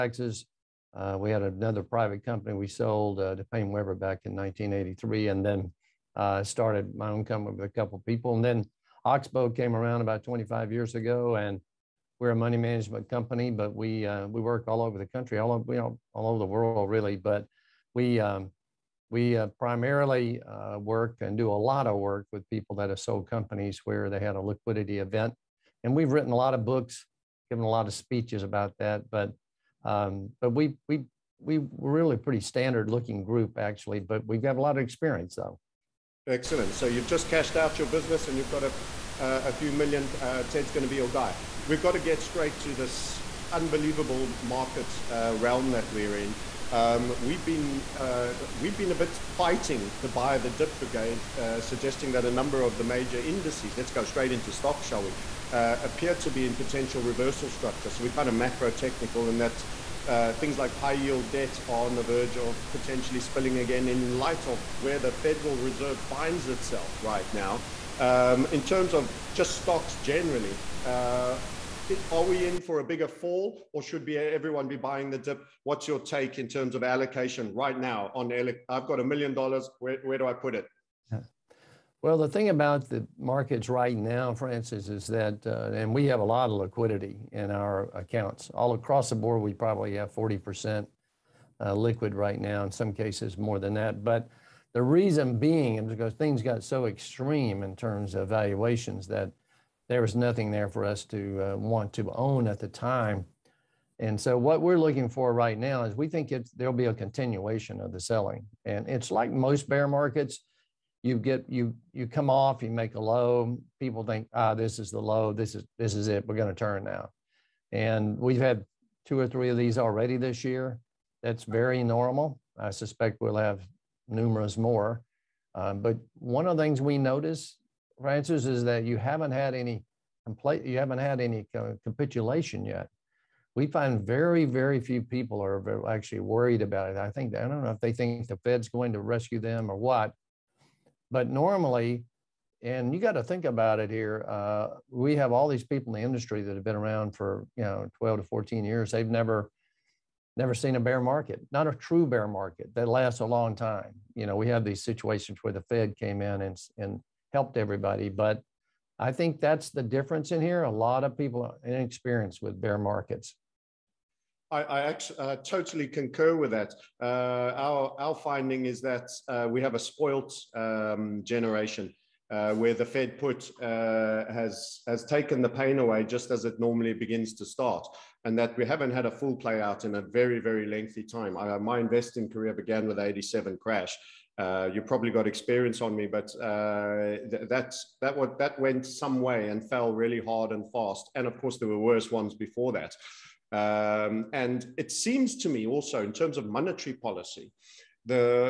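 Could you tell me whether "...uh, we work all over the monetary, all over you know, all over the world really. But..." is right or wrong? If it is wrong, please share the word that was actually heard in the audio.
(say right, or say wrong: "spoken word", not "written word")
wrong: "country", not "monetary".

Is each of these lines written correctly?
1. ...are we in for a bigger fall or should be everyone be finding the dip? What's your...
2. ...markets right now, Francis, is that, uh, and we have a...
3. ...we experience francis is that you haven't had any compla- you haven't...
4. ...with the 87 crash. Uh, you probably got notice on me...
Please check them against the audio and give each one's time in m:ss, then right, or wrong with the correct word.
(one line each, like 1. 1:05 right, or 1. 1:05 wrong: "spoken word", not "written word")
1. 1:12 wrong: "buying", not "finding"
2. 1:23 right
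3. 2:06 wrong: "notice", not "experience"
4. 3:02 wrong: "experience", not "notice".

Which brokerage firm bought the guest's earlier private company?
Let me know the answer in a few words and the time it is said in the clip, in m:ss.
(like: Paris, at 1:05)
PaineWebber, at 0:03.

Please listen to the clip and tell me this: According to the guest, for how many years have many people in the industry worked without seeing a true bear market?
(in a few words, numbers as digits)
12 to 14 years.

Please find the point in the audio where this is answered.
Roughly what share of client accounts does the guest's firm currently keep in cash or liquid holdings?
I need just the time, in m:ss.
1:30.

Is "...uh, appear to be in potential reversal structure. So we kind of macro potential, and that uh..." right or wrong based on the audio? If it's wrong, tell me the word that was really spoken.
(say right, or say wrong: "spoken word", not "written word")
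wrong: "technical", not "potential".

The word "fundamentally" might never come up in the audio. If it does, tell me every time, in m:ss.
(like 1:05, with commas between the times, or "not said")
not said.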